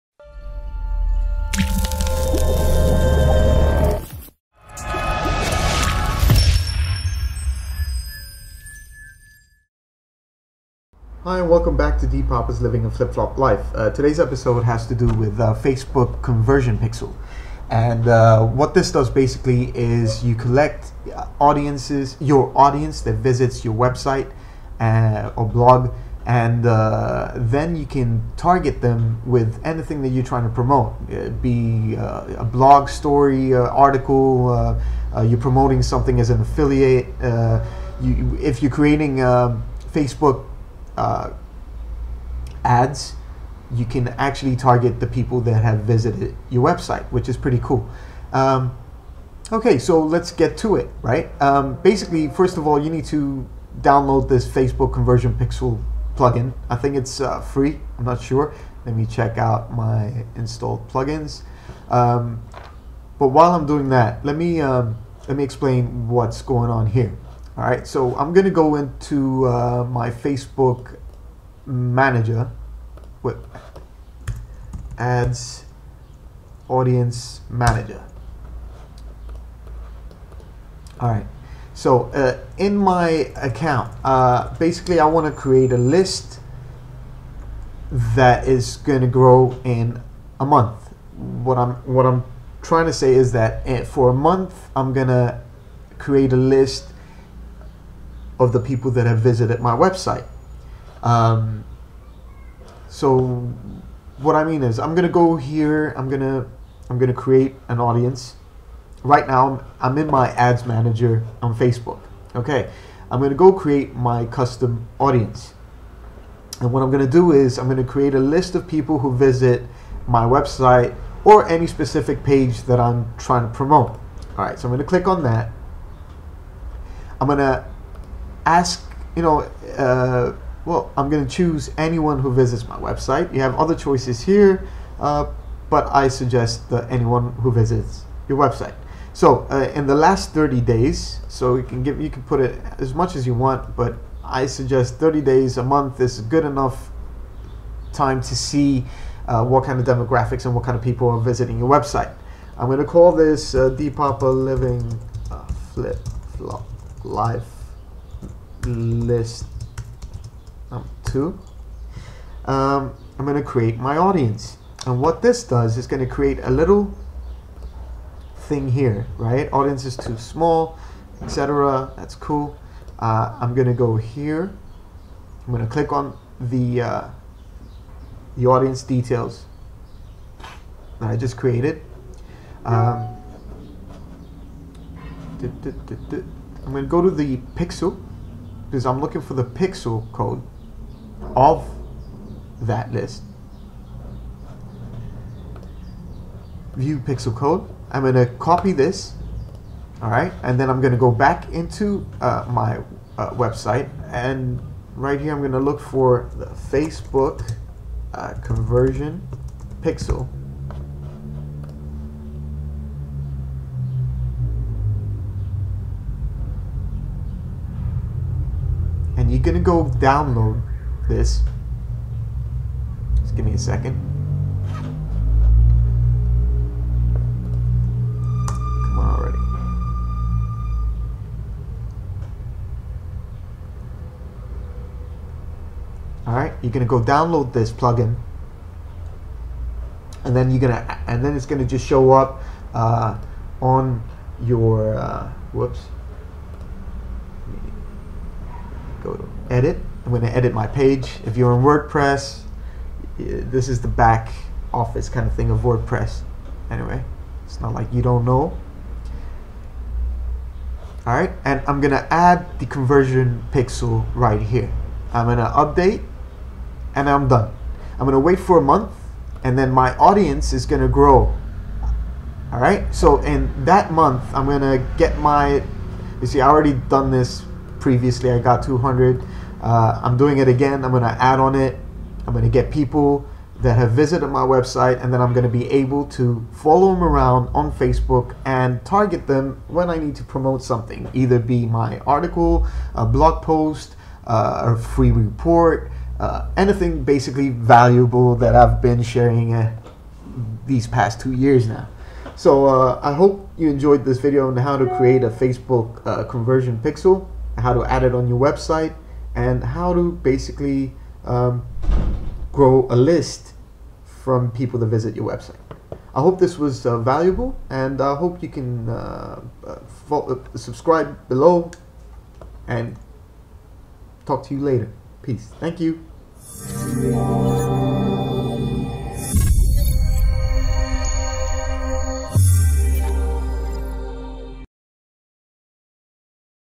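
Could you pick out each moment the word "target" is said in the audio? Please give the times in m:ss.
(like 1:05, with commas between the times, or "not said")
0:28, 0:44, 4:48.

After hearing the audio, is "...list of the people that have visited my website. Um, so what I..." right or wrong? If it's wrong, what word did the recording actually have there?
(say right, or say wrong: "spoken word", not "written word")
right.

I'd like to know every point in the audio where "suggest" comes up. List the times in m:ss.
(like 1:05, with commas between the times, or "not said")
2:16, 2:24.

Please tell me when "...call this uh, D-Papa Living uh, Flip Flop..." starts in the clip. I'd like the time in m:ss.
2:32.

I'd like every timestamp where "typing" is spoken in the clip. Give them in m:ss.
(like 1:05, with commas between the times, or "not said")
not said.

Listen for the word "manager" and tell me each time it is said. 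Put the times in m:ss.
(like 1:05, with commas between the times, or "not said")
1:11, 1:17, 1:50.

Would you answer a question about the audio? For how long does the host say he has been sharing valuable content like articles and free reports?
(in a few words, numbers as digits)
two years.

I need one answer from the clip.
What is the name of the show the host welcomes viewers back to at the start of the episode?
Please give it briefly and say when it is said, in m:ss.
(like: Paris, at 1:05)
Living a Flip Flop Life, at 0:12.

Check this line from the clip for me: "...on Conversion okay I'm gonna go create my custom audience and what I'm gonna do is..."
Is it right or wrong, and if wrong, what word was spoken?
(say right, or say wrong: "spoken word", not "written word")
wrong: "Facebook", not "Conversion".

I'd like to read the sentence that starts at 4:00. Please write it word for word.
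And then you're gonna and then it's gonna just show up uh, on your uh, whoops go to edit.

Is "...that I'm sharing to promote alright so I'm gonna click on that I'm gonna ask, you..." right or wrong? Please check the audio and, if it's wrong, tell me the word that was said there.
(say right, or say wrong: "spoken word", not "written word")
wrong: "trying", not "sharing".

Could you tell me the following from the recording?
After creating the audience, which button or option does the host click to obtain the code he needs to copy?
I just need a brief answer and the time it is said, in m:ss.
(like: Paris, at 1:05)
View pixel code, at 3:16.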